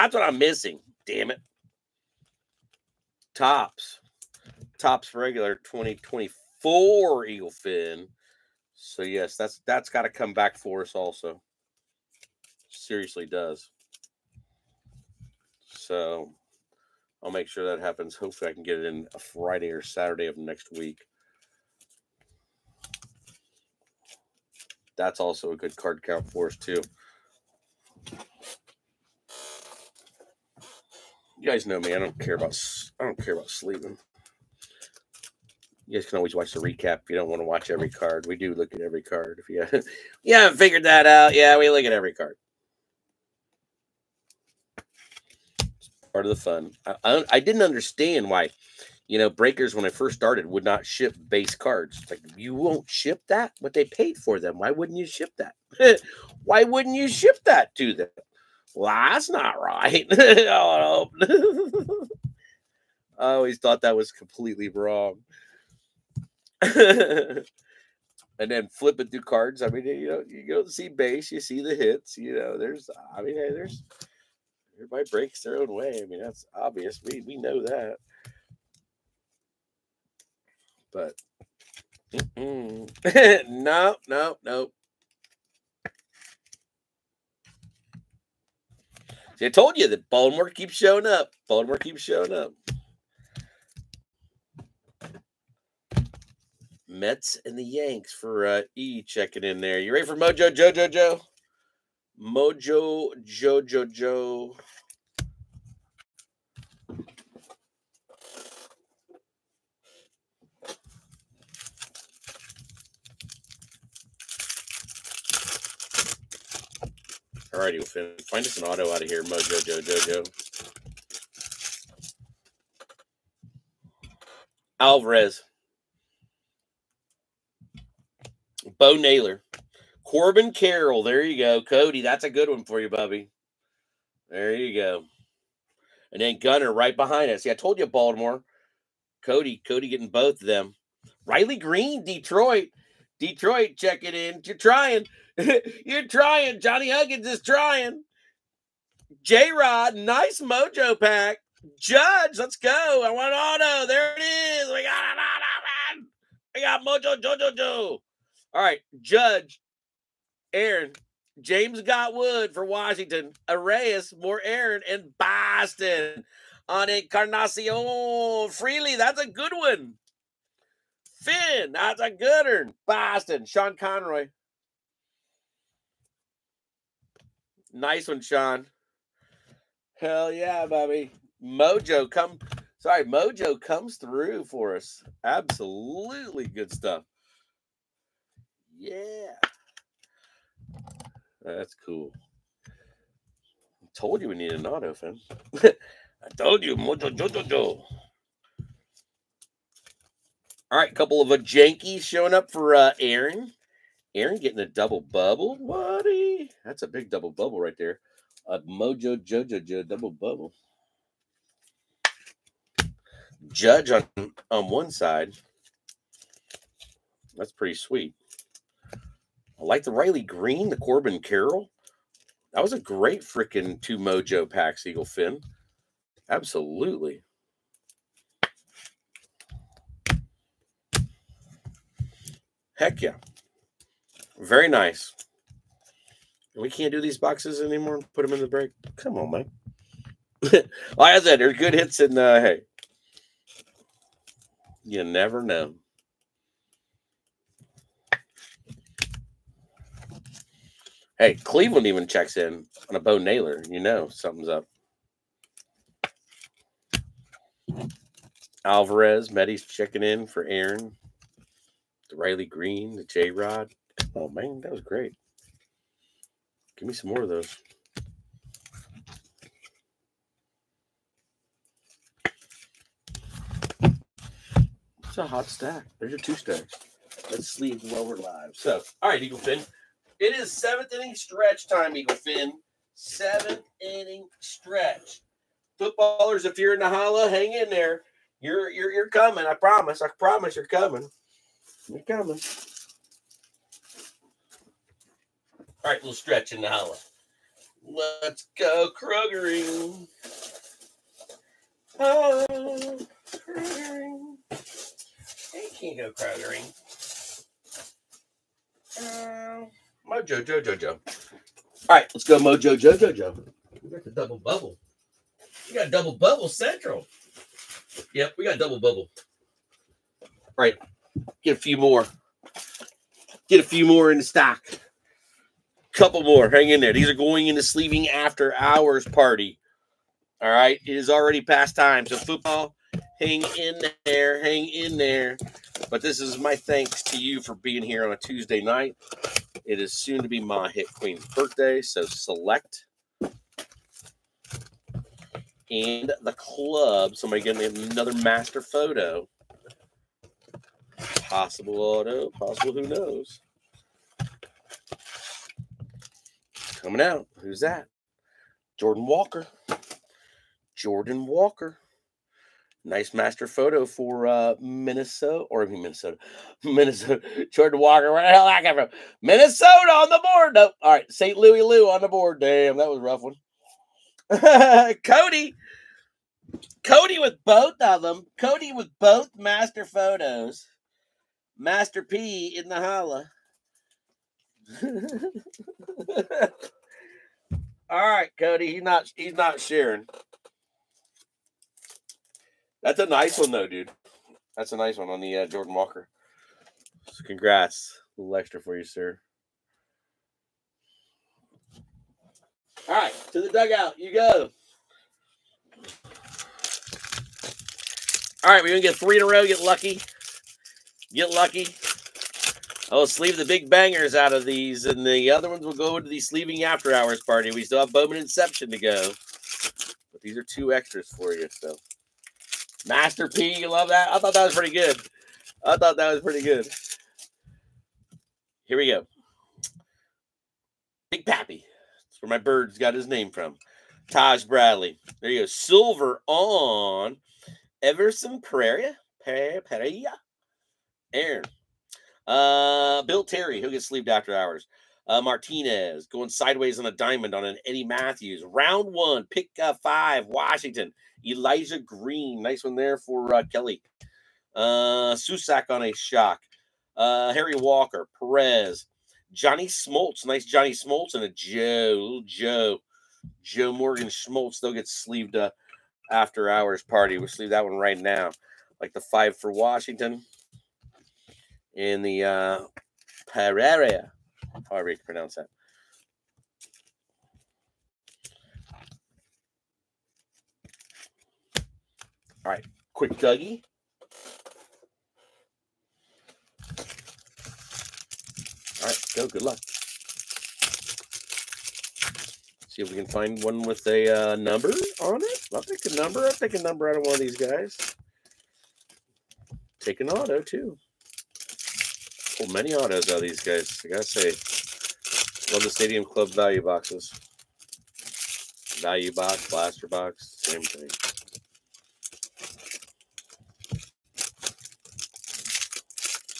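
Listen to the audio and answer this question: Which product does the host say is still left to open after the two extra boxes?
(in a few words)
Bowman Inception.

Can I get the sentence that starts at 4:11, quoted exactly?
Hey, Cleveland even checks in on a Bo Naylor.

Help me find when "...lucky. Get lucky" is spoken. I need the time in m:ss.
6:49.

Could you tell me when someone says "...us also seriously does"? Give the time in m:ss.
0:10.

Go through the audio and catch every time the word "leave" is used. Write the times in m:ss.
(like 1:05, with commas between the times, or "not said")
4:37.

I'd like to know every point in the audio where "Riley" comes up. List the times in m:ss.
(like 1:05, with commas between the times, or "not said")
2:21, 3:39, 4:22.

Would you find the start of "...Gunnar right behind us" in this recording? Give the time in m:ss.
2:16.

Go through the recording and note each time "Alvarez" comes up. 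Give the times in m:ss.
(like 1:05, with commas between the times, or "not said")
2:04, 4:18.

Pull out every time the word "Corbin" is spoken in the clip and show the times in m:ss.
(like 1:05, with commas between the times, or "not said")
2:10, 3:40.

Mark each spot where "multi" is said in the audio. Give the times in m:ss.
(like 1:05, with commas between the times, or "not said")
not said.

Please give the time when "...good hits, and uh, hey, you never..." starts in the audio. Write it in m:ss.
4:01.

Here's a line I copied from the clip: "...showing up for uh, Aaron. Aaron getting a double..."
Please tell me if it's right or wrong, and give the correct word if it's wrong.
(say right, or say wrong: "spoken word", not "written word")
right.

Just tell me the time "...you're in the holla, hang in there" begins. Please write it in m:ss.
4:46.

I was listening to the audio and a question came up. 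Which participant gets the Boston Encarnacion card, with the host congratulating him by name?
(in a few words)
Sean Conroy.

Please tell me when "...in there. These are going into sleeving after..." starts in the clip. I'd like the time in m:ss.
5:26.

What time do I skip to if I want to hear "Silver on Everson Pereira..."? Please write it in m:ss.
7:15.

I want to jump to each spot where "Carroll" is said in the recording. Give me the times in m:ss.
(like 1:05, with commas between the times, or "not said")
2:10, 3:41.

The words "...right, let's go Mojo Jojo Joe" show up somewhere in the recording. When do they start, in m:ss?
5:11.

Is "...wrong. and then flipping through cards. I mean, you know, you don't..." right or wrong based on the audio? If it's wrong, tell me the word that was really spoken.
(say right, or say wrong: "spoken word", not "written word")
right.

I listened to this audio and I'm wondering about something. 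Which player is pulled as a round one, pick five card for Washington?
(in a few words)
Elijah Green.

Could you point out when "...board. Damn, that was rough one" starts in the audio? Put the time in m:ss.
6:12.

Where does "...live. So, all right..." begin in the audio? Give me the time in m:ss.
4:38.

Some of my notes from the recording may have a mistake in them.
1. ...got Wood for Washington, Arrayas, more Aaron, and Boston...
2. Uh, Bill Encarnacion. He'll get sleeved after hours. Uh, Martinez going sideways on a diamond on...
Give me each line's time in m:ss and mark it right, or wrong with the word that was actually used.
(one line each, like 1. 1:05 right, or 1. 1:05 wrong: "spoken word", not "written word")
1. 2:41 right
2. 7:22 wrong: "Terry", not "Encarnacion".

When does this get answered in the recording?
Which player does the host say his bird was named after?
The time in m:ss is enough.
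7:11.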